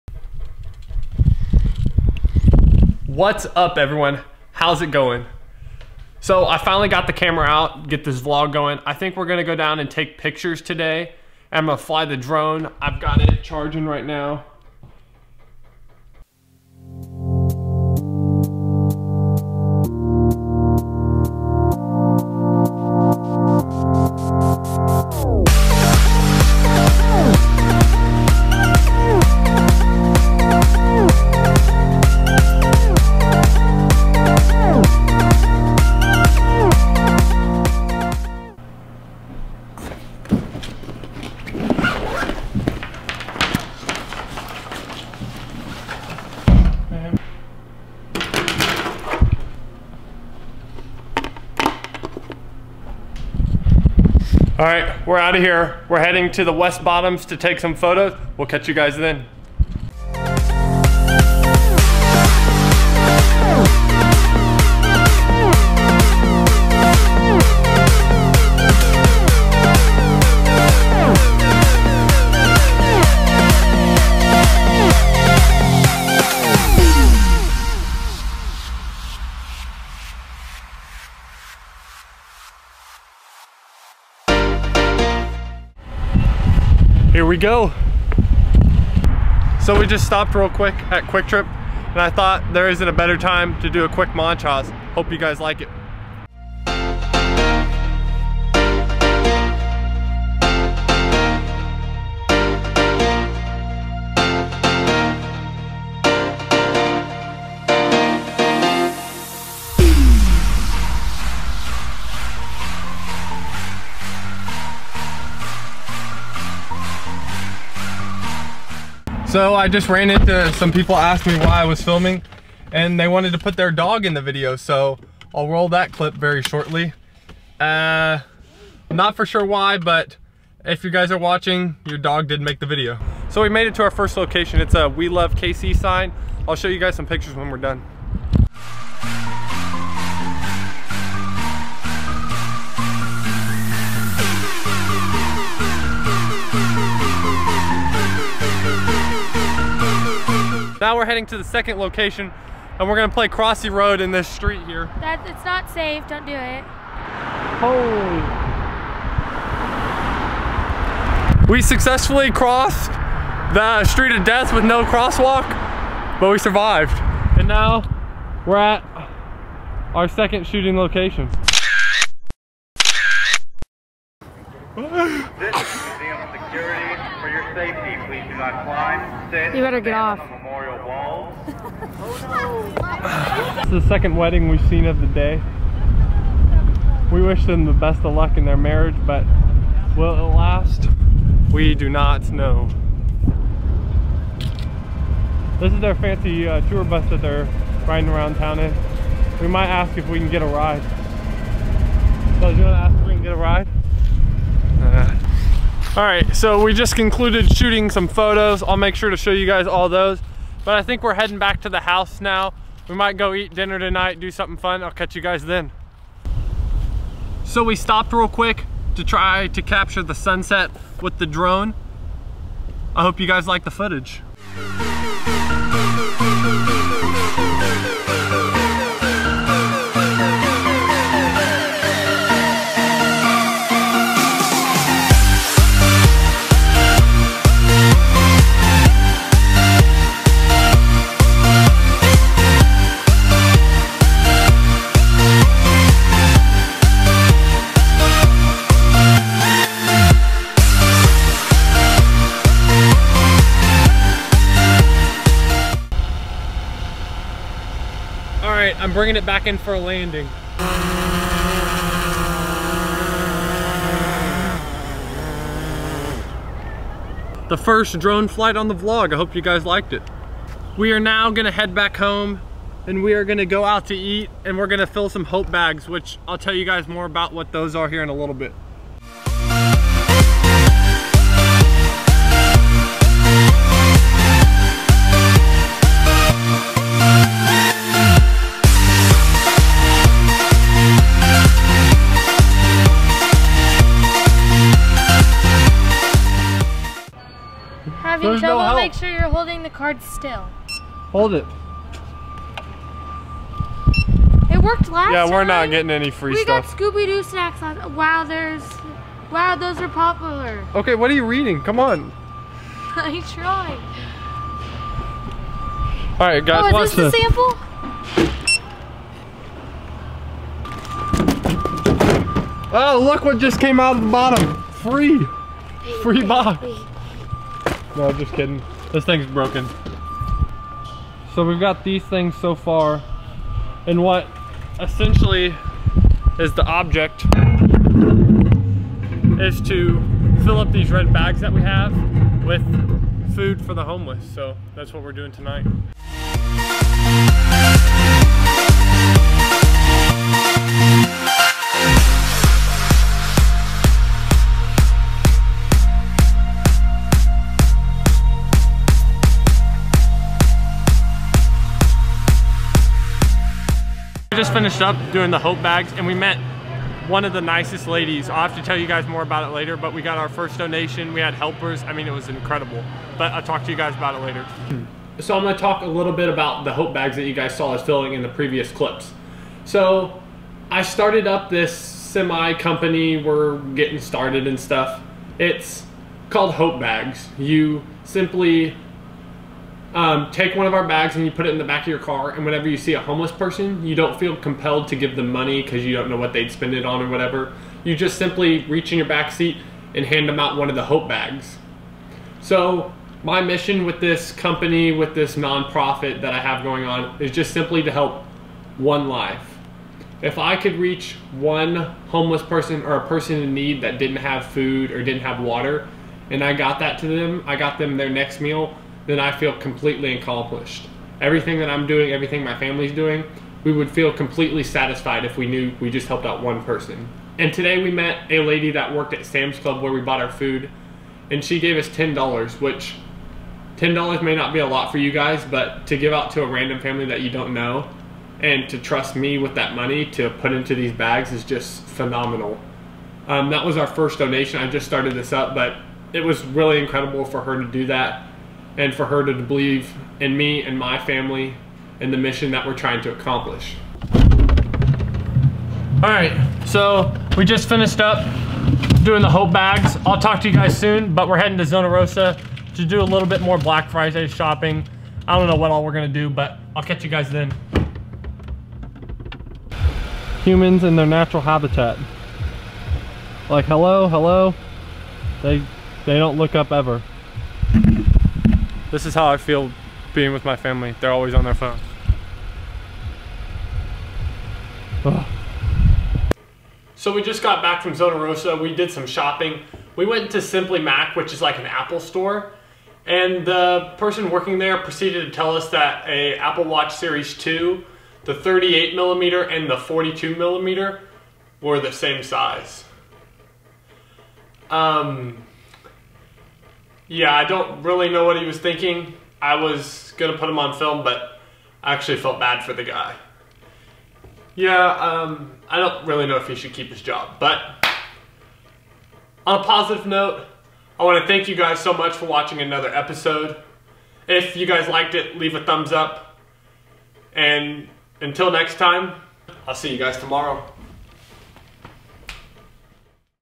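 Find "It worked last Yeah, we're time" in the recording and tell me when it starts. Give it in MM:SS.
05:04.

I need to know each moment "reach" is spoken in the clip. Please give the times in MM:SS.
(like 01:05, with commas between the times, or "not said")
06:38, 06:50.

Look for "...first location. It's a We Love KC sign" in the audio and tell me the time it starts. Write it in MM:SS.
02:13.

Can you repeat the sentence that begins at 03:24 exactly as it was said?
Uh, all right, so we just concluded shooting some photos.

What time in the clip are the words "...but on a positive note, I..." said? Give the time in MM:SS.
08:37.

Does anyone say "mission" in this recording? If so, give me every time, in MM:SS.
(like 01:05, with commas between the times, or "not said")
06:43, 07:32.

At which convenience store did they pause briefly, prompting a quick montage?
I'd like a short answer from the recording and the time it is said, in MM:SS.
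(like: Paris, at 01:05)
QuikTrip, at 01:31.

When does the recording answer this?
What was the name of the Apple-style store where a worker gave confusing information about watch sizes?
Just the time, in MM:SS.
08:10.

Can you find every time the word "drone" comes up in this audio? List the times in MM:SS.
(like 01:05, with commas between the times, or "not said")
00:12, 03:41, 04:27.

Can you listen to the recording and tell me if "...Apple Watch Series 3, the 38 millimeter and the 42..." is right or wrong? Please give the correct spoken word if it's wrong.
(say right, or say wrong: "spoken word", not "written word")
wrong: "2", not "3".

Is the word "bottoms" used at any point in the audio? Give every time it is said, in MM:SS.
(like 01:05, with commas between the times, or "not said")
00:56, 05:24.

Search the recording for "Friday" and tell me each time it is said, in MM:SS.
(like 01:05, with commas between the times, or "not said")
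07:43.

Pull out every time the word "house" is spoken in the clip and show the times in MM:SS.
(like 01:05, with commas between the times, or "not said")
03:31.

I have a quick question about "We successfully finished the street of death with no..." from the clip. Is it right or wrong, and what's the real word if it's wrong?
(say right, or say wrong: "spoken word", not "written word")
wrong: "crossed", not "finished".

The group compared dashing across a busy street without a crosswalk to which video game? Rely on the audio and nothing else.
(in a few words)
Crossy Road.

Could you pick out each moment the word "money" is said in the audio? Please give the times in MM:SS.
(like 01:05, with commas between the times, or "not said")
06:35, 07:19.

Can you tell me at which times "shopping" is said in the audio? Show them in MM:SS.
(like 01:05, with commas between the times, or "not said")
07:44, 08:09.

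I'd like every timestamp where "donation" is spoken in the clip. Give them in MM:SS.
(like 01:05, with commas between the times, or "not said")
06:10, 07:24.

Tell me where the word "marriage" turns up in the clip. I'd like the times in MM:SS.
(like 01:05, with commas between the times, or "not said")
03:08.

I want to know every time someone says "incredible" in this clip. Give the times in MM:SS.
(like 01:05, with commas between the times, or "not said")
06:12, 07:26.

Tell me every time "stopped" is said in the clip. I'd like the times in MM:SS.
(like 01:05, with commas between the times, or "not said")
01:30, 03:37.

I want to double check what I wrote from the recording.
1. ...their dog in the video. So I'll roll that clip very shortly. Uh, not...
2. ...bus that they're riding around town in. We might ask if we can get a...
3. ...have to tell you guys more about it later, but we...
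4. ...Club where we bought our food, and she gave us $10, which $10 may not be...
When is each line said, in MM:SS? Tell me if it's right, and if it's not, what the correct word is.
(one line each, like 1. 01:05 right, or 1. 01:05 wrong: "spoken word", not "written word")
1. 02:03 right
2. 03:16 right
3. 06:08 right
4. 07:09 right.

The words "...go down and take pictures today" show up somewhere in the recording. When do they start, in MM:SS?
00:09.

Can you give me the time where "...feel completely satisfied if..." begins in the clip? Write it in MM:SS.
07:03.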